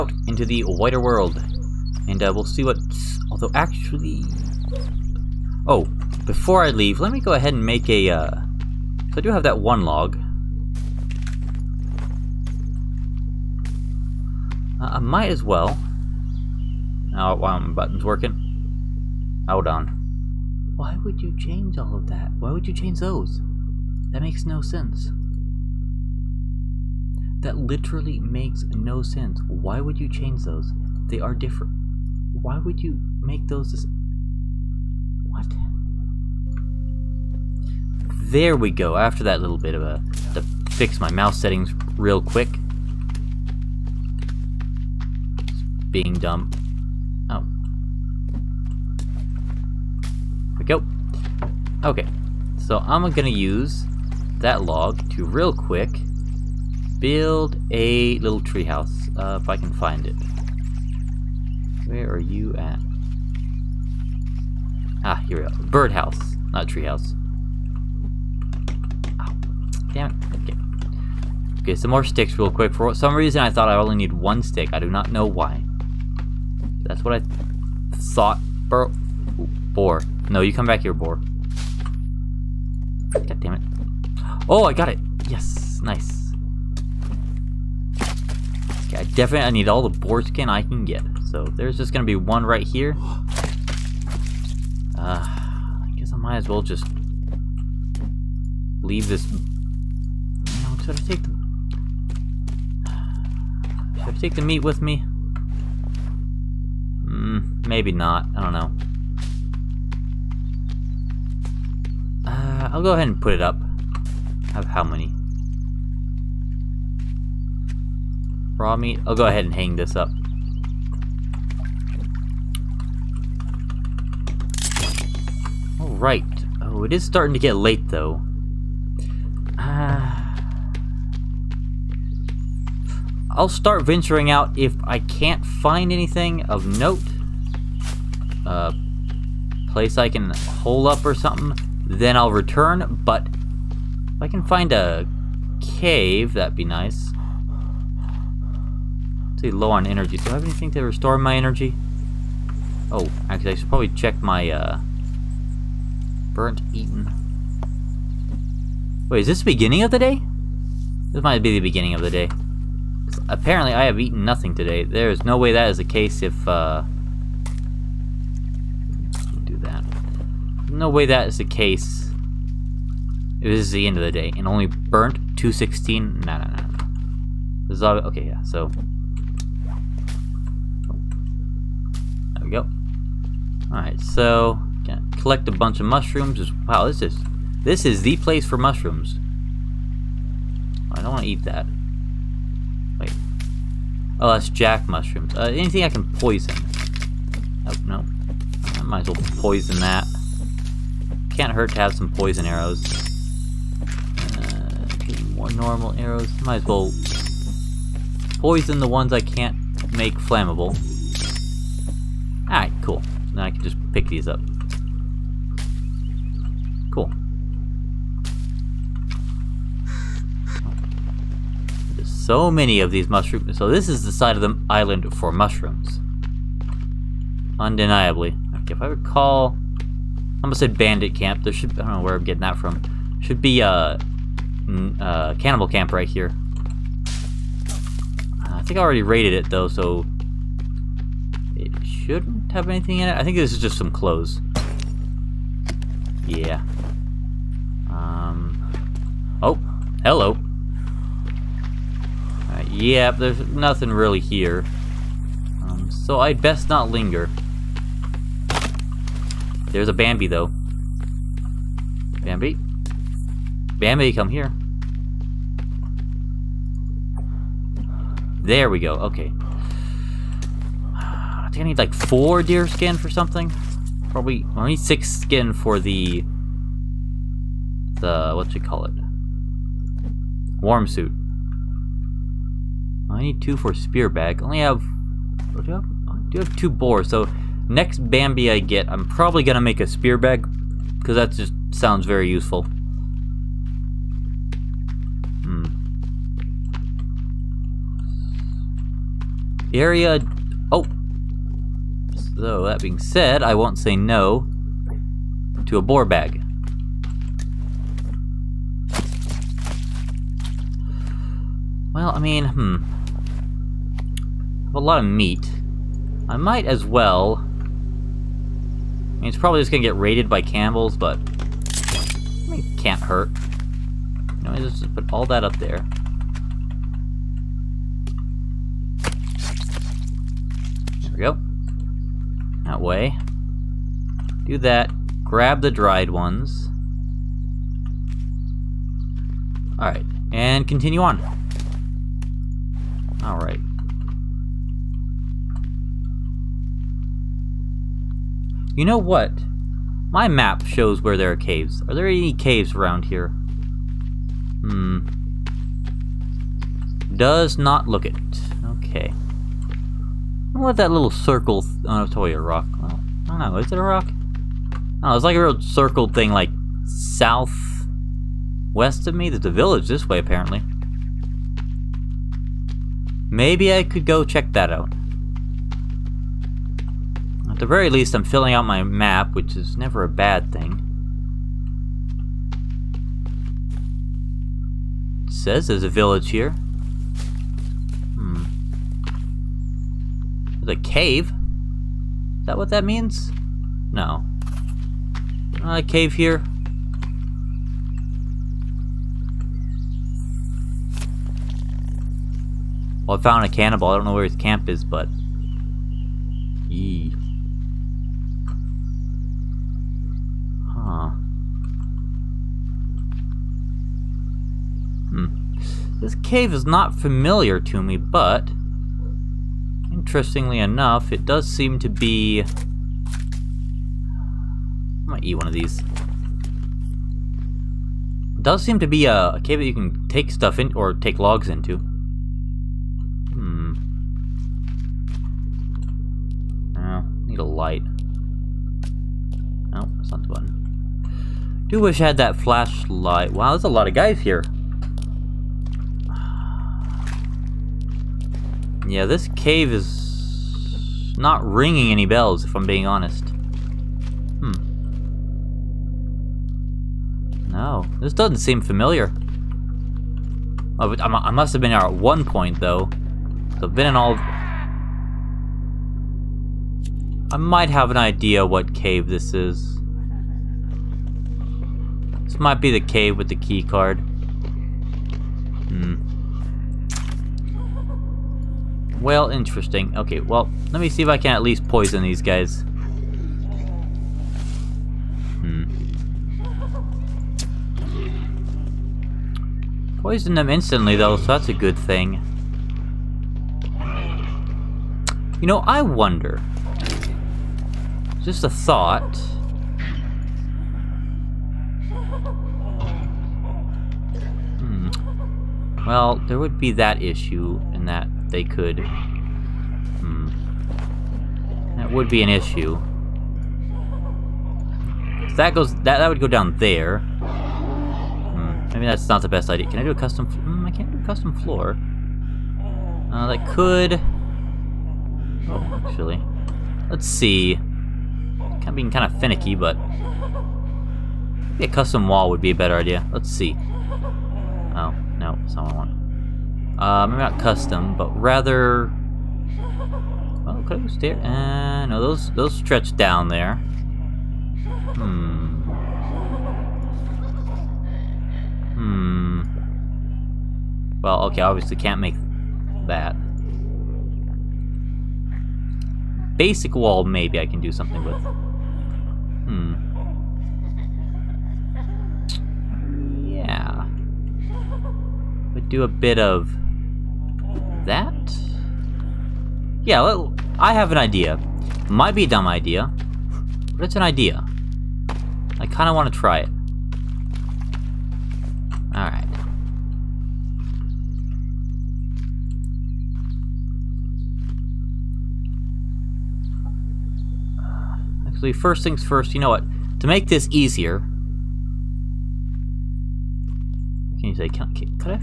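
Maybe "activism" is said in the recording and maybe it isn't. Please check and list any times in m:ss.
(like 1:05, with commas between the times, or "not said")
not said.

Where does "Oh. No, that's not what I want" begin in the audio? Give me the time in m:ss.
8:54.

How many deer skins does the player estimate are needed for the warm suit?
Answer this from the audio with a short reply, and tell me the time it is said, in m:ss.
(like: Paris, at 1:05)
6, at 4:34.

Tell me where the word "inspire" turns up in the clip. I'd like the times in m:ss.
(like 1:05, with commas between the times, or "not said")
not said.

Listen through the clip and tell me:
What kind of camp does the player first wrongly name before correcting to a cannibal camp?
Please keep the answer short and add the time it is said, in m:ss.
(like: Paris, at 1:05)
Bandit camp, at 3:50.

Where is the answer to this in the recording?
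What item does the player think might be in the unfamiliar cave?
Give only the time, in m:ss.
7:53.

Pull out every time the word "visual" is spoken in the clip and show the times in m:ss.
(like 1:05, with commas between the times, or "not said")
not said.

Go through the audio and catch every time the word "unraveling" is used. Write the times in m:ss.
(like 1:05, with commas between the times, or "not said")
not said.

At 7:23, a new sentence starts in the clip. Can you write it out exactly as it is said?
Wow, there's a lot of guys here.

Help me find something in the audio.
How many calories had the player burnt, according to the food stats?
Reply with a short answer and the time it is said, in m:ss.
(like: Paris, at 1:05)
216, at 2:55.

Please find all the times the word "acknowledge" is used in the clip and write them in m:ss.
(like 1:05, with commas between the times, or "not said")
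not said.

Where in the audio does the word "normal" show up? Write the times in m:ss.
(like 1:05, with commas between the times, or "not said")
3:25.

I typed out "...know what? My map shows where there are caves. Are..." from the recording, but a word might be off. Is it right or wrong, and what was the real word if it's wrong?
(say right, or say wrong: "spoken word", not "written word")
right.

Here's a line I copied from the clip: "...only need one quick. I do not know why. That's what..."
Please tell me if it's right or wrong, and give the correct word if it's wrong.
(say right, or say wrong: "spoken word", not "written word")
wrong: "stick", not "quick".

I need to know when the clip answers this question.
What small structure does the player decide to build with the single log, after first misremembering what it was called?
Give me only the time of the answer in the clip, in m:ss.
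1:05.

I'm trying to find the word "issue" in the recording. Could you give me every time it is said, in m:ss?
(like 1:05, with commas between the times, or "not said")
8:27, 8:32.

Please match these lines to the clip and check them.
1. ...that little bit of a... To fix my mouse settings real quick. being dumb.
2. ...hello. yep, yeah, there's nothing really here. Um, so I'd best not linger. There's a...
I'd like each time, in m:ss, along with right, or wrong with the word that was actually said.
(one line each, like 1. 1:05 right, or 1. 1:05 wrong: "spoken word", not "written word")
1. 0:39 right
2. 4:10 right.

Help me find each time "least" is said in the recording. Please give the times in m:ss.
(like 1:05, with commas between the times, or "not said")
6:17, 8:01.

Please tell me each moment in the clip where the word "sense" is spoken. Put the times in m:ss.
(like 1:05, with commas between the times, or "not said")
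0:24, 0:29.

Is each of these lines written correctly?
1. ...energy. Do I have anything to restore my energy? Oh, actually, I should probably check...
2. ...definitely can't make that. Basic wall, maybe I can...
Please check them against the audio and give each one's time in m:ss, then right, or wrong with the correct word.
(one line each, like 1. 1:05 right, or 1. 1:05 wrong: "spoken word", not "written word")
1. 2:29 right
2. 9:11 wrong: "obviously", not "definitely".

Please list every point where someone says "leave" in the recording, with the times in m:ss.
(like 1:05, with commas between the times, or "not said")
0:06, 1:38.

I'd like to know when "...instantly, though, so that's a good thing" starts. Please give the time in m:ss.
8:10.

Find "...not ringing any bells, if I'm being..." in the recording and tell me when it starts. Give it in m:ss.
7:31.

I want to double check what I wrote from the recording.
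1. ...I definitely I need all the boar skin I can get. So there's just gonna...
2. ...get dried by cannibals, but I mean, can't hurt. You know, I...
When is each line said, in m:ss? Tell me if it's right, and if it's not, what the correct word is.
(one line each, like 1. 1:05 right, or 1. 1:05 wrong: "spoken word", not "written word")
1. 1:28 right
2. 5:19 wrong: "raided", not "dried".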